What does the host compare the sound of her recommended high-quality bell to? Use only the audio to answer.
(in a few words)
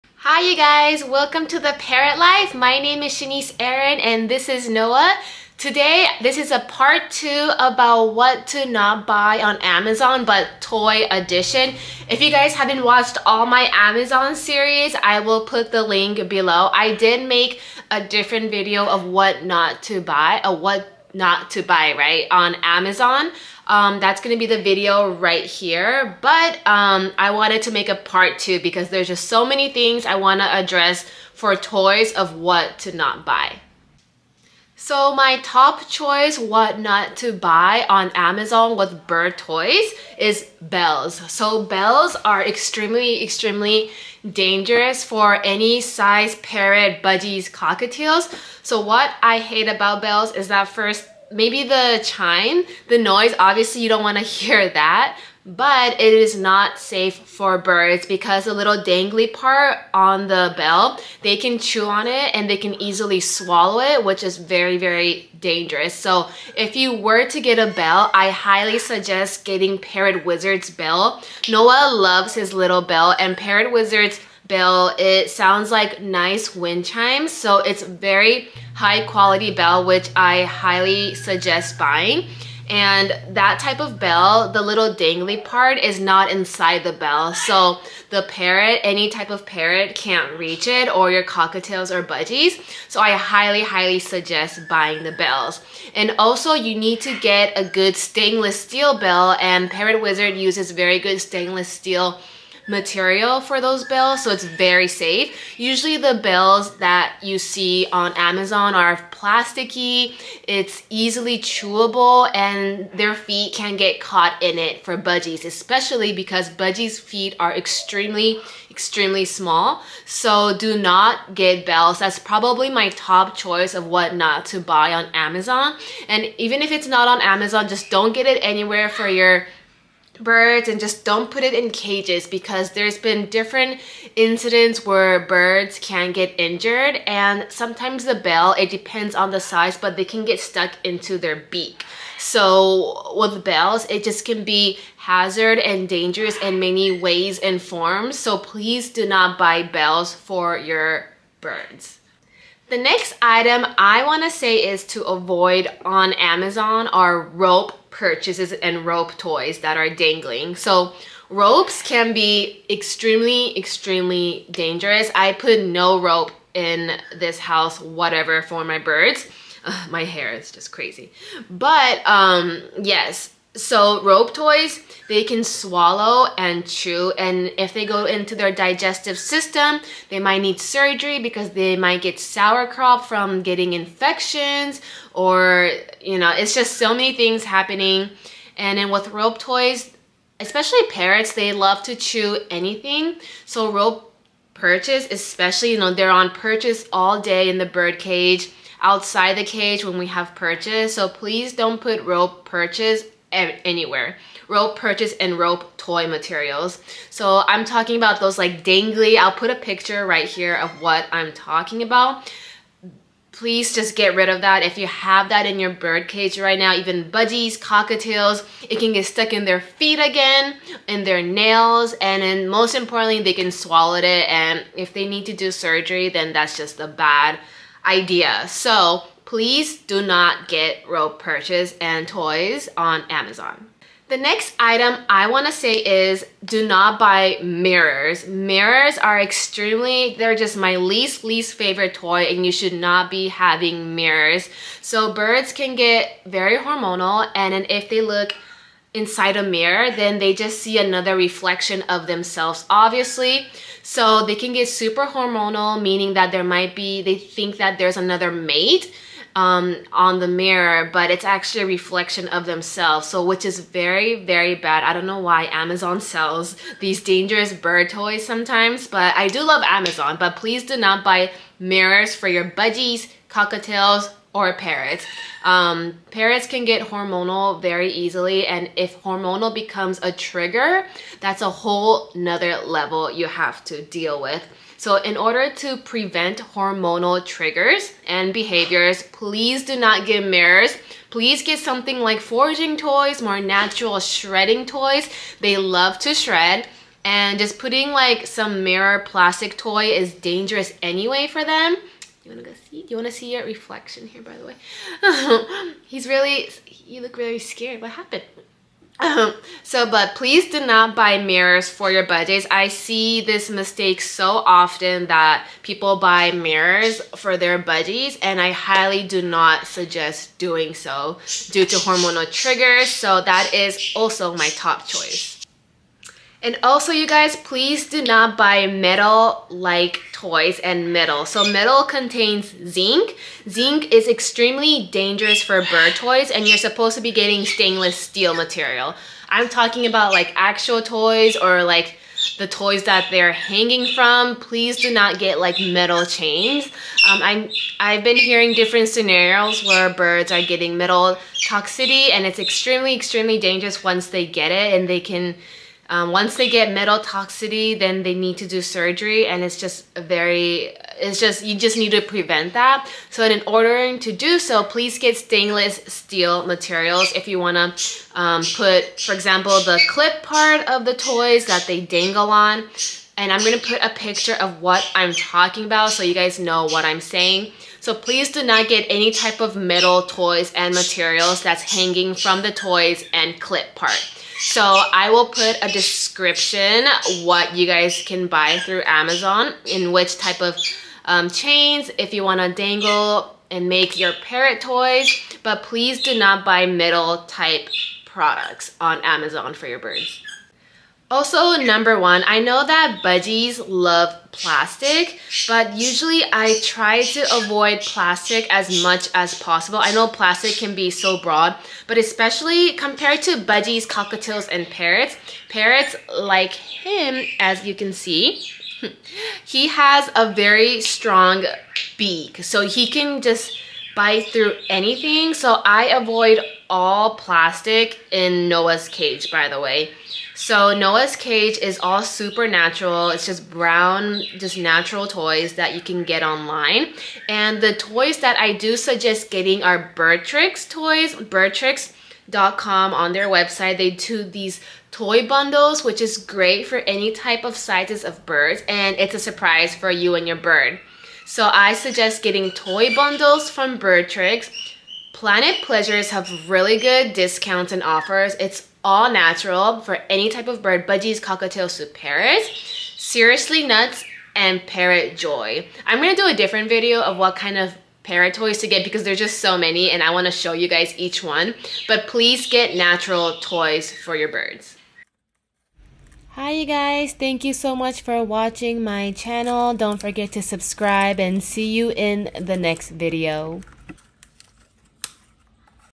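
wind chimes.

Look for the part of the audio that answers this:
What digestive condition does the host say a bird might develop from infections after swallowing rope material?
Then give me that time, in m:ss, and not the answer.
3:02.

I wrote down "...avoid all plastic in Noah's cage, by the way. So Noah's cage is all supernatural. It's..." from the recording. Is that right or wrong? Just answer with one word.
right.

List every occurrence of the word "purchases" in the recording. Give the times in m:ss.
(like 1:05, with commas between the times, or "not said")
2:37, 3:24.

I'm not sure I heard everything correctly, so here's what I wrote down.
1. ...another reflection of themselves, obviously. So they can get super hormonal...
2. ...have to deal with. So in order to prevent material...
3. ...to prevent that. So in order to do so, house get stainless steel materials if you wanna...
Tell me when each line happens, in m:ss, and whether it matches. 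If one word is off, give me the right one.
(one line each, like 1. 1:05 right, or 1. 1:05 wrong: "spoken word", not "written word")
1. 4:10 right
2. 4:43 wrong: "hormonal", not "material"
3. 6:01 wrong: "please", not "house".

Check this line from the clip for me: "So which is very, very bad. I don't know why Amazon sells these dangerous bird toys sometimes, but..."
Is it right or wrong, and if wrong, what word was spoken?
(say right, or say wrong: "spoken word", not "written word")
right.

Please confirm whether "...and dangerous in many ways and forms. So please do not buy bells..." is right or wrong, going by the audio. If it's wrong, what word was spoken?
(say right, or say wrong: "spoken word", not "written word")
right.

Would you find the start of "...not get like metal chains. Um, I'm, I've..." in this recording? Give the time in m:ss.
5:44.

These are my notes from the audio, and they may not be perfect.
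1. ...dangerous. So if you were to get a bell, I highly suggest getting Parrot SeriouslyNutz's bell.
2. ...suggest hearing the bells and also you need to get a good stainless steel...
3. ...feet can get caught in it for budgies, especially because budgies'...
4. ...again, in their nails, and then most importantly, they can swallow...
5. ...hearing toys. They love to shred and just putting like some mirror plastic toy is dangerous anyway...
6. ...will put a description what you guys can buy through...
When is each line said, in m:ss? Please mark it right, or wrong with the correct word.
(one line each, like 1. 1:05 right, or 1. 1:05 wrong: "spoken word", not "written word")
1. 1:05 wrong: "Wizard", not "SeriouslyNutz"
2. 1:33 wrong: "buying", not "hearing"
3. 1:53 right
4. 3:39 right
5. 4:53 wrong: "shredding", not "hearing"
6. 6:25 right.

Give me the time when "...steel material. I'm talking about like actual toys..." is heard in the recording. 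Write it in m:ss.
5:37.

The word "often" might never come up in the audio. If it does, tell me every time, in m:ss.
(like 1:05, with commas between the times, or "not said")
5:14.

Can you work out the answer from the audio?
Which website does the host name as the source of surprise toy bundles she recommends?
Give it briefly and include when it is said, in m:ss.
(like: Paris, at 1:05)
birdtricks.com, at 7:21.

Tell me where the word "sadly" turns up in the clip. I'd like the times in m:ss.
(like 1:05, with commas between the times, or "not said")
not said.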